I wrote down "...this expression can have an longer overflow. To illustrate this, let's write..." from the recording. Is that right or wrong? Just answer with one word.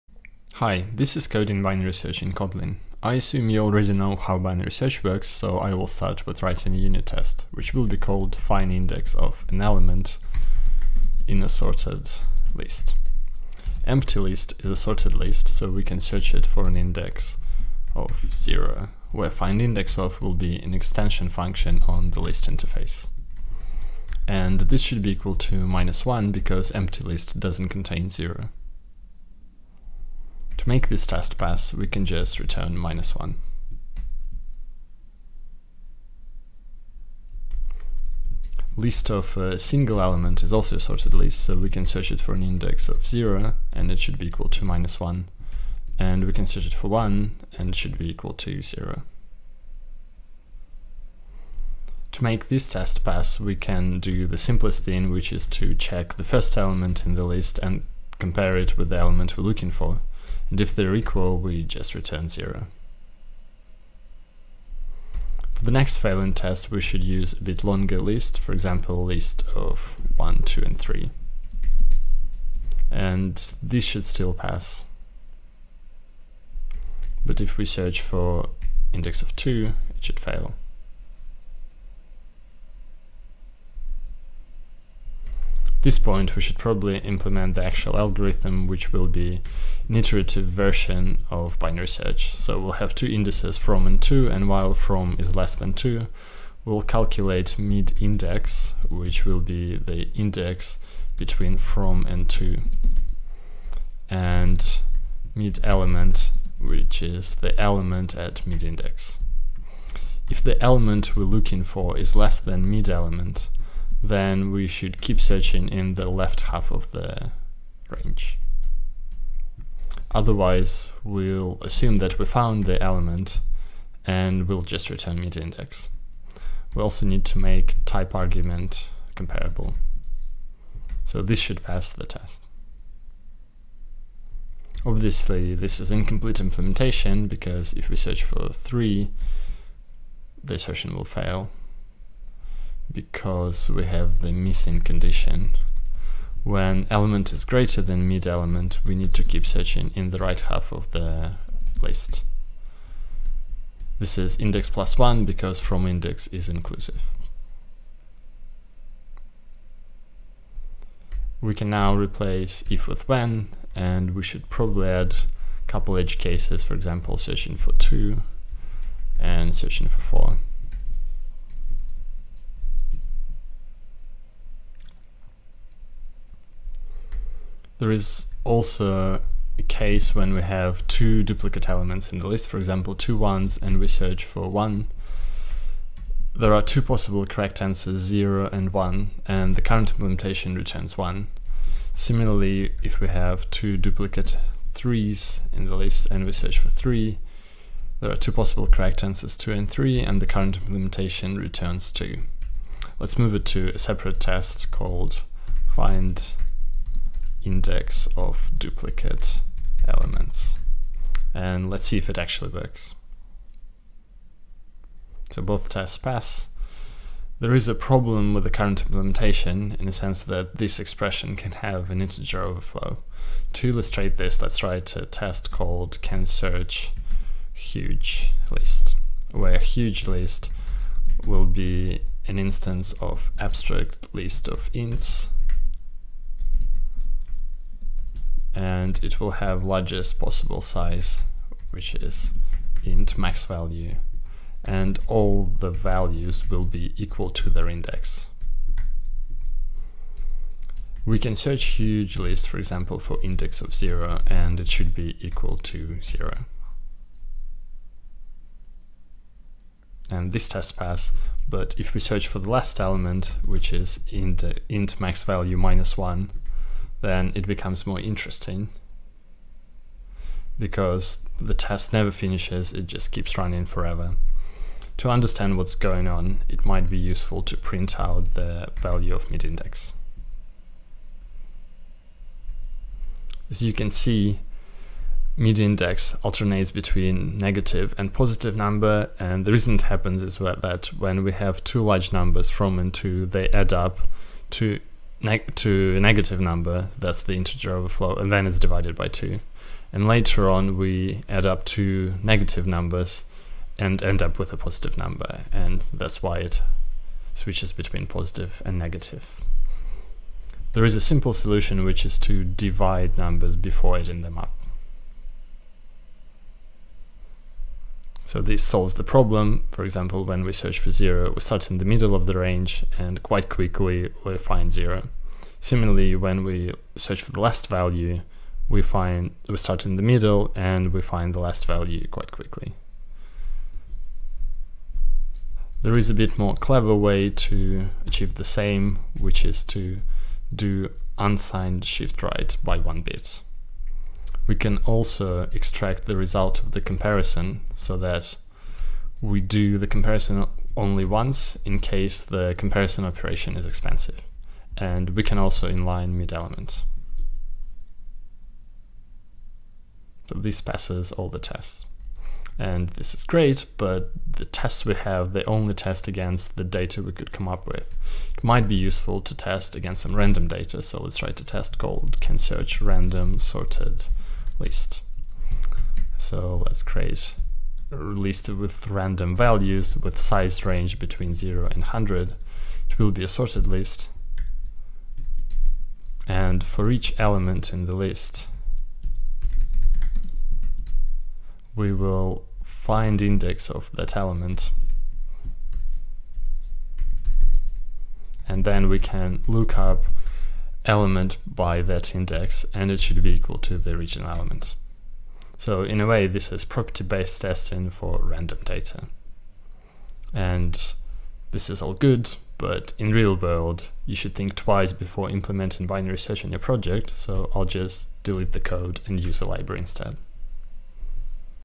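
wrong.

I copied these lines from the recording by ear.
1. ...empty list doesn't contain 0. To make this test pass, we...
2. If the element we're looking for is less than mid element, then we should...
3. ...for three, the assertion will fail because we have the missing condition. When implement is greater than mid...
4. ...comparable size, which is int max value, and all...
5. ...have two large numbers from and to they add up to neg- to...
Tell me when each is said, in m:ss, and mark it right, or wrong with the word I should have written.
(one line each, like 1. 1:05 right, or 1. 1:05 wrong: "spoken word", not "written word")
1. 0:26 right
2. 1:50 right
3. 2:18 wrong: "element", not "implement"
4. 4:00 wrong: "possible", not "comparable"
5. 4:51 right.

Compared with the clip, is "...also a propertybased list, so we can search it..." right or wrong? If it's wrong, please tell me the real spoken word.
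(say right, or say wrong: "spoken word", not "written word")
wrong: "sorted", not "propertybased".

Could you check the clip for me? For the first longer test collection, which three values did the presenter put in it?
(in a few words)
1, 2, and 3.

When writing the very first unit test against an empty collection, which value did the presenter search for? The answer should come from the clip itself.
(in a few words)
0.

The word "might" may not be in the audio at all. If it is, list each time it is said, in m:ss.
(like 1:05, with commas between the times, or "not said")
4:36, 6:08.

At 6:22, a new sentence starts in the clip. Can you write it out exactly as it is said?
It will be a sorted list.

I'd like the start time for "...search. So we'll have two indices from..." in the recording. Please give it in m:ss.
1:31.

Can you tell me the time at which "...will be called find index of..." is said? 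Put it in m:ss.
0:07.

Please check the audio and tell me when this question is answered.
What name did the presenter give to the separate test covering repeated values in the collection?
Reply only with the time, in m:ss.
3:25.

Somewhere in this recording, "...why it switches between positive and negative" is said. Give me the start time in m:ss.
5:06.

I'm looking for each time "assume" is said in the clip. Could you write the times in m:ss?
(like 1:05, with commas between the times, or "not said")
0:03, 2:01.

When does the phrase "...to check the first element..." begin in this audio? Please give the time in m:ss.
0:55.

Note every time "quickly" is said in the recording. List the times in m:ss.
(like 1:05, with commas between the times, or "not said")
5:23, 5:32.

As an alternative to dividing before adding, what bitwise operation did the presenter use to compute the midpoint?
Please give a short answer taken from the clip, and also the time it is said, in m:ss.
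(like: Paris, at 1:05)
unsigned shift right, at 5:41.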